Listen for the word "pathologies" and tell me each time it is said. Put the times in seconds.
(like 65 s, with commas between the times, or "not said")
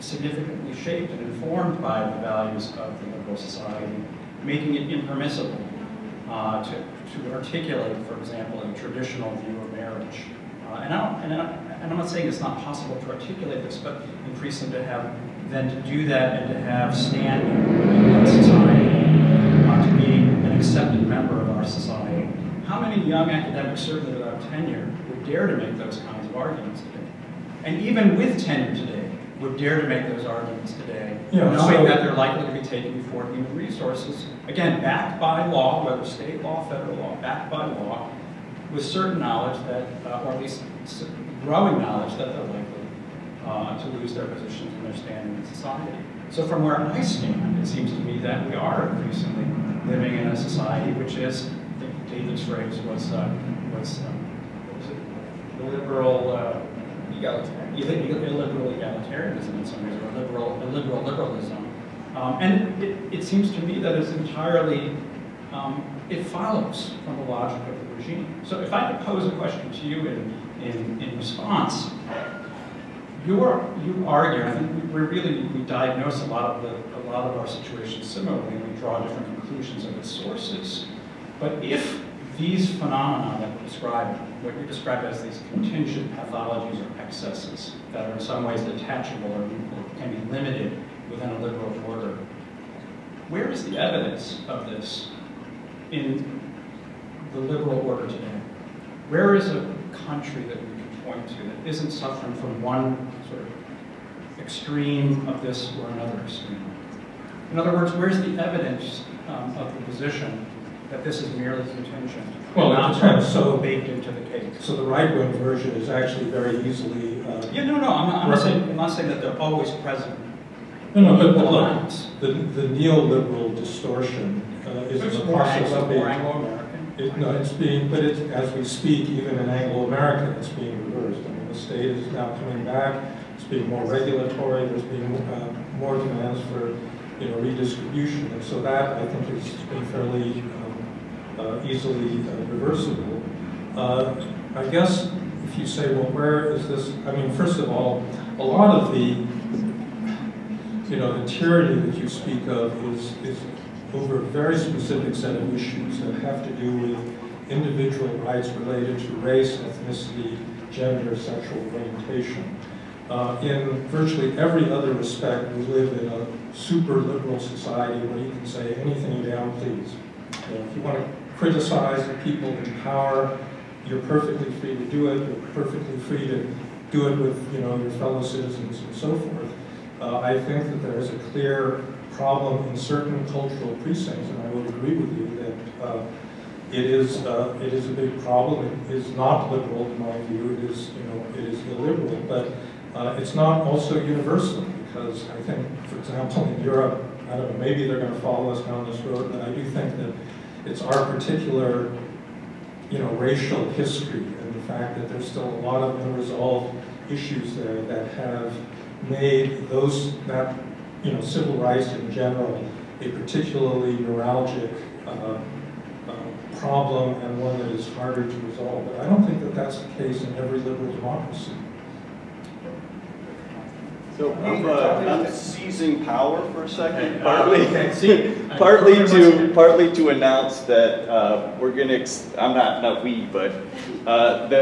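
86 s.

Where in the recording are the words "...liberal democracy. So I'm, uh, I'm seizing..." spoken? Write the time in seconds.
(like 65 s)
220 s.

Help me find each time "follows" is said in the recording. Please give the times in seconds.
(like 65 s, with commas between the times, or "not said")
66 s, 198 s.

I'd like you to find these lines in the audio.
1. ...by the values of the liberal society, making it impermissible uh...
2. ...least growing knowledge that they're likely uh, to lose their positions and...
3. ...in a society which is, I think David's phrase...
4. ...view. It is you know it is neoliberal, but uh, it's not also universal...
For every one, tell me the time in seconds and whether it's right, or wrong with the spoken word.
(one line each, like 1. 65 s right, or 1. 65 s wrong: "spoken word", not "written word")
1. 1 s right
2. 40 s right
3. 50 s right
4. 190 s wrong: "illiberal", not "neoliberal".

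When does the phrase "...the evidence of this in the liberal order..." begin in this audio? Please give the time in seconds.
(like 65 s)
93 s.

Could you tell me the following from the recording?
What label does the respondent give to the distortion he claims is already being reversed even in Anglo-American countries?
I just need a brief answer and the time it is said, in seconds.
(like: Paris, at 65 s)
neoliberal distortion, at 122 s.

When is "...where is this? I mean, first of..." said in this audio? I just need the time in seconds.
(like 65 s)
146 s.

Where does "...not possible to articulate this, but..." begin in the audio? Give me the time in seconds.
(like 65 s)
12 s.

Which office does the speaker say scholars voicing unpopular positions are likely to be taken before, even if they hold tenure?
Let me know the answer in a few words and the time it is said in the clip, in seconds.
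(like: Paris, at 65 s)
human resources, at 33 s.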